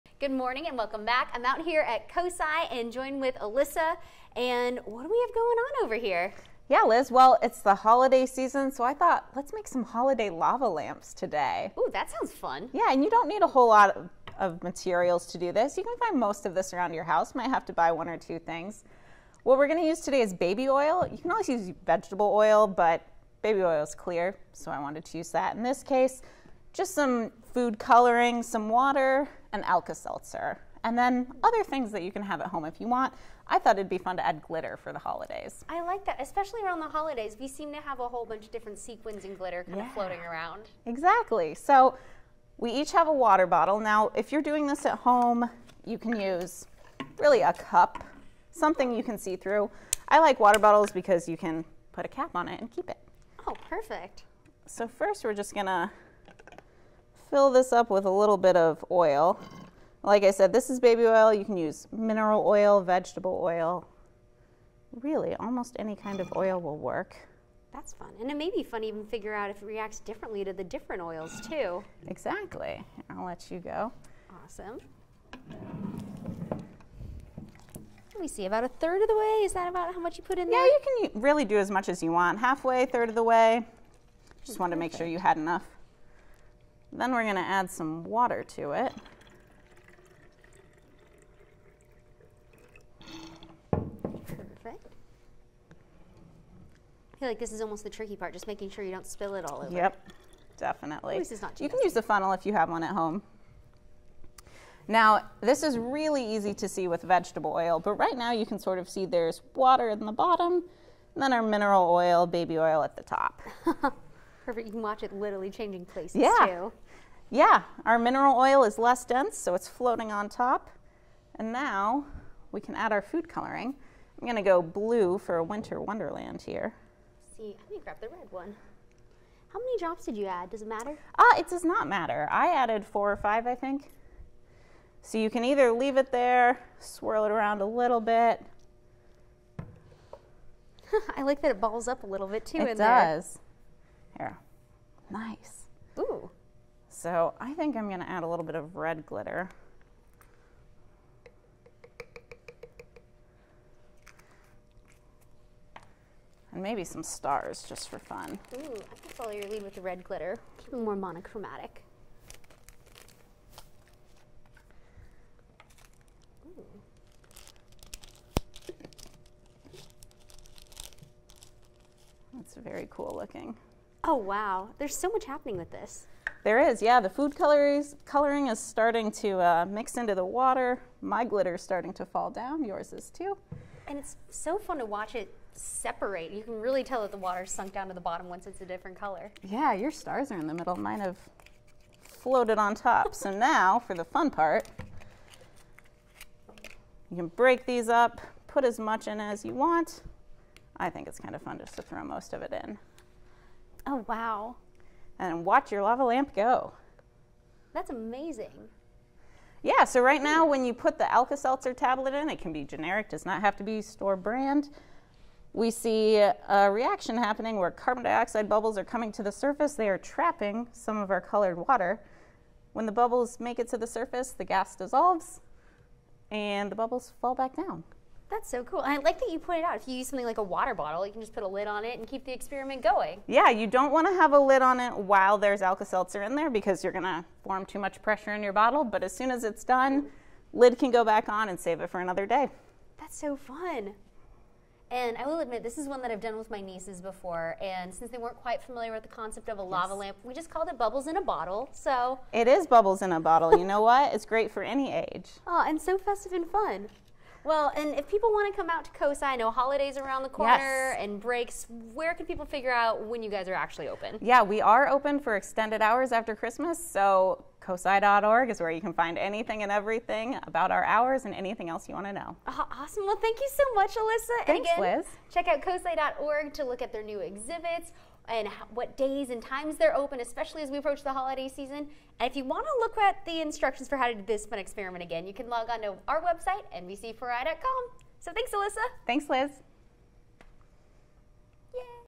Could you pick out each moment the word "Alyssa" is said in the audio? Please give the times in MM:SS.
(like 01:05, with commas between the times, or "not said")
00:03, 04:33, 04:48.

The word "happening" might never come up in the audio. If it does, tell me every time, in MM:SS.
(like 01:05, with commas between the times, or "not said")
02:55, 03:37.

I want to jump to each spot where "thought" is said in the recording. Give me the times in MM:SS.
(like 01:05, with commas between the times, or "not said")
00:08, 00:33.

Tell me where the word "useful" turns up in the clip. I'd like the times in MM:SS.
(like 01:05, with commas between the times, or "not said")
not said.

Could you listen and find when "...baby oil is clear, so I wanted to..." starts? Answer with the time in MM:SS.
00:23.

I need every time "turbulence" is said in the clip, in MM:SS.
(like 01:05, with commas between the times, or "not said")
not said.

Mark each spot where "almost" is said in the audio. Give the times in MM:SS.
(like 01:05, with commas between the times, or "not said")
01:05, 01:37.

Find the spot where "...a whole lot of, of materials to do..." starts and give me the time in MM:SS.
00:13.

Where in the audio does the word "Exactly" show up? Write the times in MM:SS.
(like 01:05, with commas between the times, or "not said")
00:40, 01:12.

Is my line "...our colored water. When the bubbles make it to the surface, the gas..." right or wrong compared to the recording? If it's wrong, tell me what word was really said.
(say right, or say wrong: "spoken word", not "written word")
right.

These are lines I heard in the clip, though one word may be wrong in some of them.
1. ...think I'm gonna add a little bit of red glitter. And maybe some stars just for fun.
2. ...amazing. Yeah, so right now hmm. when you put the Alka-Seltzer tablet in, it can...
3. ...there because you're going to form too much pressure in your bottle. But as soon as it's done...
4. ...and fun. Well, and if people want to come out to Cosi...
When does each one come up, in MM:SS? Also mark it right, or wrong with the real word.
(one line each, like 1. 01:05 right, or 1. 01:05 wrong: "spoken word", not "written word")
1. 02:27 right
2. 03:27 right
3. 03:56 right
4. 04:16 right.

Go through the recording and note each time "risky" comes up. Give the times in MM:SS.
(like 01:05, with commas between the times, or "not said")
not said.